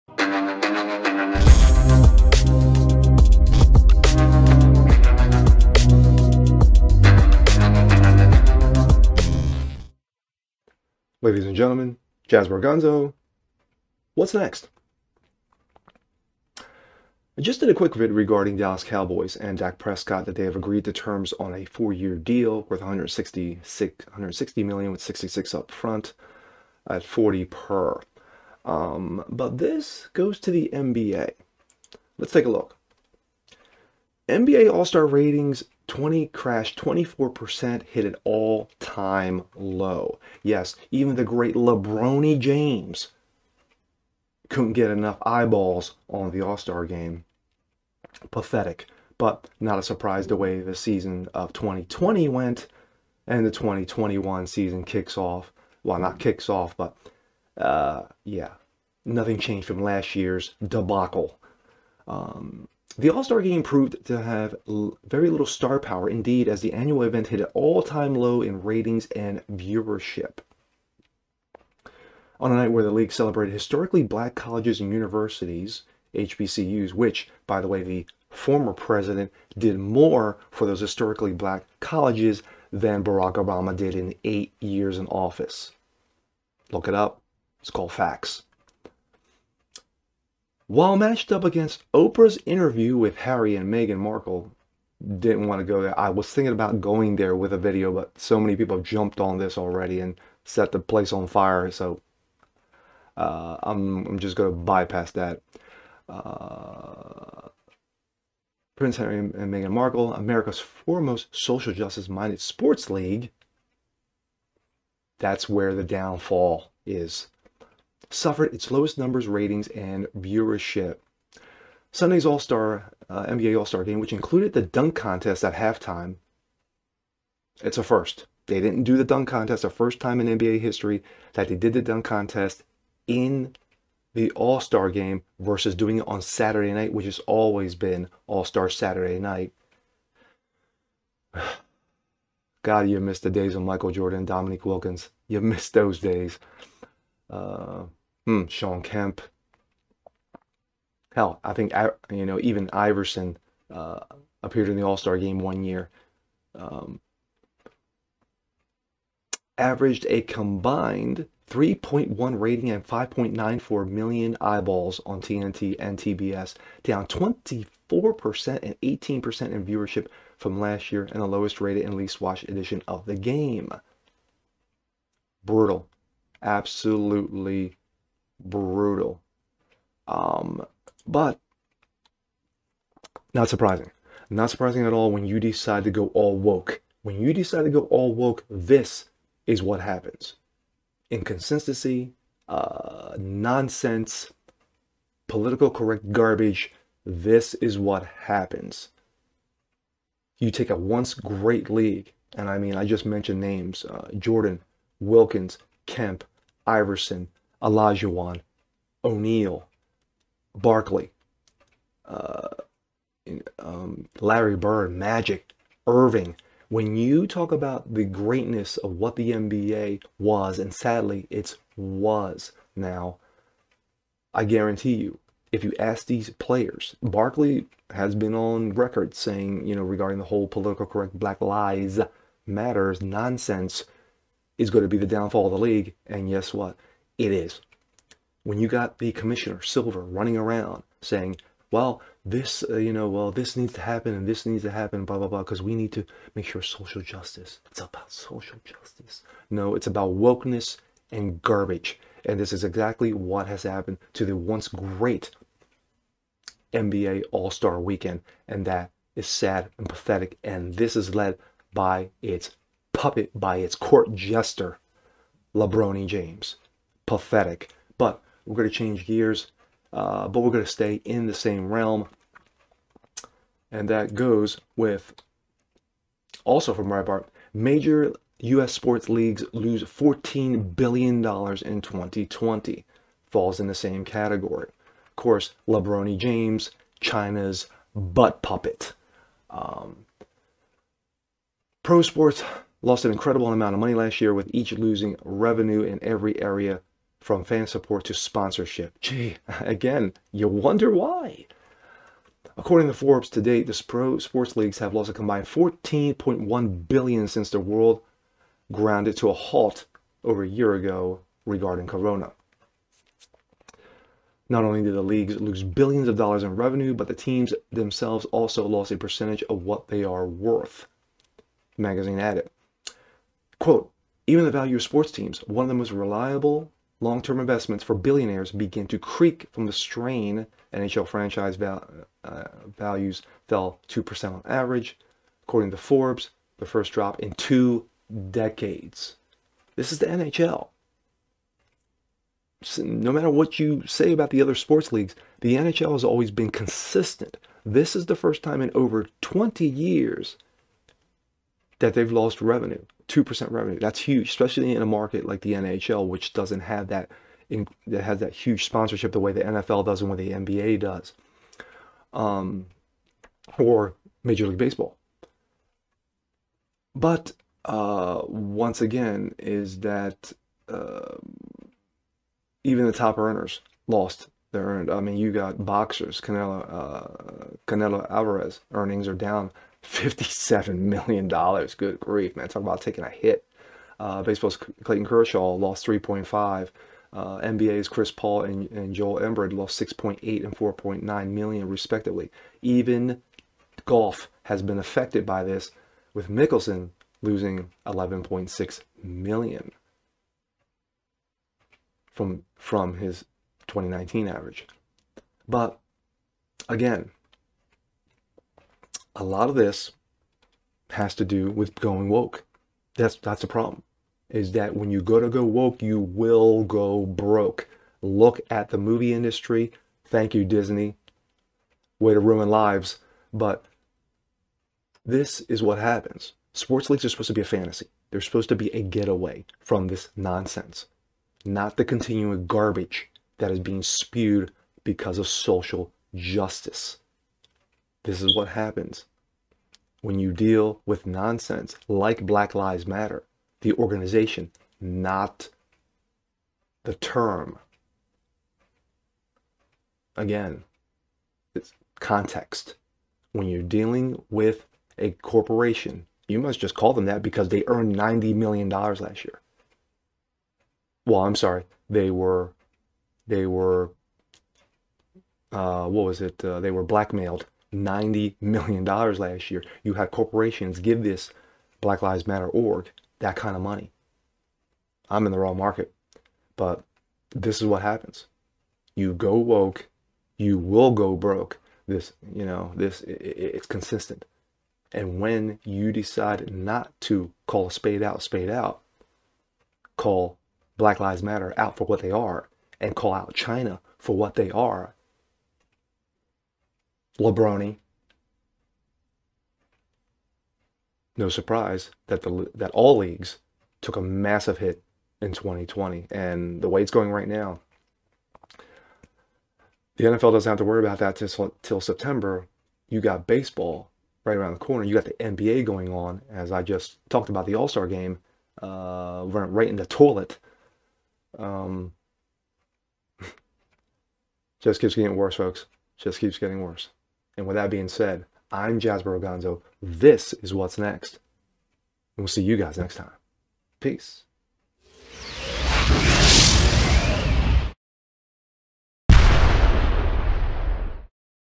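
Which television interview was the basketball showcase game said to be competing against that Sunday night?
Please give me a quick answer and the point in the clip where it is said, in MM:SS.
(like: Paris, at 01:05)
Oprah's interview, at 01:31.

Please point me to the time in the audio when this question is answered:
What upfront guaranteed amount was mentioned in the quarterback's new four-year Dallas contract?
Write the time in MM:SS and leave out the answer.
00:25.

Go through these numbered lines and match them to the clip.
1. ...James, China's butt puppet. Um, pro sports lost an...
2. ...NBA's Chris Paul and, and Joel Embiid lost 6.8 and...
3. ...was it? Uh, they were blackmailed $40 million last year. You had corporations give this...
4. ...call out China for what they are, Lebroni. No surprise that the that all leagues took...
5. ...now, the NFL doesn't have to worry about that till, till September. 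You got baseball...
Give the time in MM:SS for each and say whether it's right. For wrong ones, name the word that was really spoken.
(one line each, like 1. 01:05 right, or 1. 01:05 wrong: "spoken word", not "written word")
1. 04:46 right
2. 06:27 right
3. 07:46 wrong: "90", not "40"
4. 08:12 right
5. 08:27 right.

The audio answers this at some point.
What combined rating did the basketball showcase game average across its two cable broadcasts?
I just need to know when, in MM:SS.
02:41.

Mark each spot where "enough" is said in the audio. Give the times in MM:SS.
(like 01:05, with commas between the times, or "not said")
00:44.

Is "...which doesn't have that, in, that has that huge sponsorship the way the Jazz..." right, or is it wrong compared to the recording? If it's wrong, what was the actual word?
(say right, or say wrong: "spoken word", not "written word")
wrong: "NFL", not "Jazz".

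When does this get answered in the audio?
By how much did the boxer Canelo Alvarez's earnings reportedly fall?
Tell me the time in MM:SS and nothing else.
06:19.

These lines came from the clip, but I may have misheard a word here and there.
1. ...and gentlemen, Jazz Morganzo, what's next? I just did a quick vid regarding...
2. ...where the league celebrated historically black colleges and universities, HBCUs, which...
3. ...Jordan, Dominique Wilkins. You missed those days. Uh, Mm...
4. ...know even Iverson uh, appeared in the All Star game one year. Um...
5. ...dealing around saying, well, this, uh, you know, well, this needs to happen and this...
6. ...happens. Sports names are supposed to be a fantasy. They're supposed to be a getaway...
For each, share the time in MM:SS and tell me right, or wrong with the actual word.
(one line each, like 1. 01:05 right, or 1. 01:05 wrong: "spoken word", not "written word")
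1. 00:11 right
2. 01:12 right
3. 02:23 right
4. 02:32 right
5. 03:59 wrong: "running", not "dealing"
6. 07:05 wrong: "leagues", not "names".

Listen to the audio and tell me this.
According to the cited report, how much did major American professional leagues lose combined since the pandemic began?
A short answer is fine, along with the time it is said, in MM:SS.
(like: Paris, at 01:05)
14.1 billion, at 05:05.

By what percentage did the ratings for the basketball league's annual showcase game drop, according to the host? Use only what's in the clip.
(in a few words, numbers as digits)
24%.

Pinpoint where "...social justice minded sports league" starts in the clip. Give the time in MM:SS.
01:51.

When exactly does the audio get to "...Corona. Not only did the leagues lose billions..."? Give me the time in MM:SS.
05:11.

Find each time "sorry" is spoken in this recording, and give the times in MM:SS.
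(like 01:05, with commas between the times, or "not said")
07:41.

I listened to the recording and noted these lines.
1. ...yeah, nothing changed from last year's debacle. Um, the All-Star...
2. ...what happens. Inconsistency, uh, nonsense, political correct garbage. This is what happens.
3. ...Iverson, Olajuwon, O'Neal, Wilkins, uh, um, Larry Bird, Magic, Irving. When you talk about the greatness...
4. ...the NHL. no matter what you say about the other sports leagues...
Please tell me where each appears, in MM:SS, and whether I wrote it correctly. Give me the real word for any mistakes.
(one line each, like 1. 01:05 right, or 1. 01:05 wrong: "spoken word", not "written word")
1. 00:58 right
2. 03:09 right
3. 03:26 wrong: "Barkley", not "Wilkins"
4. 05:39 right.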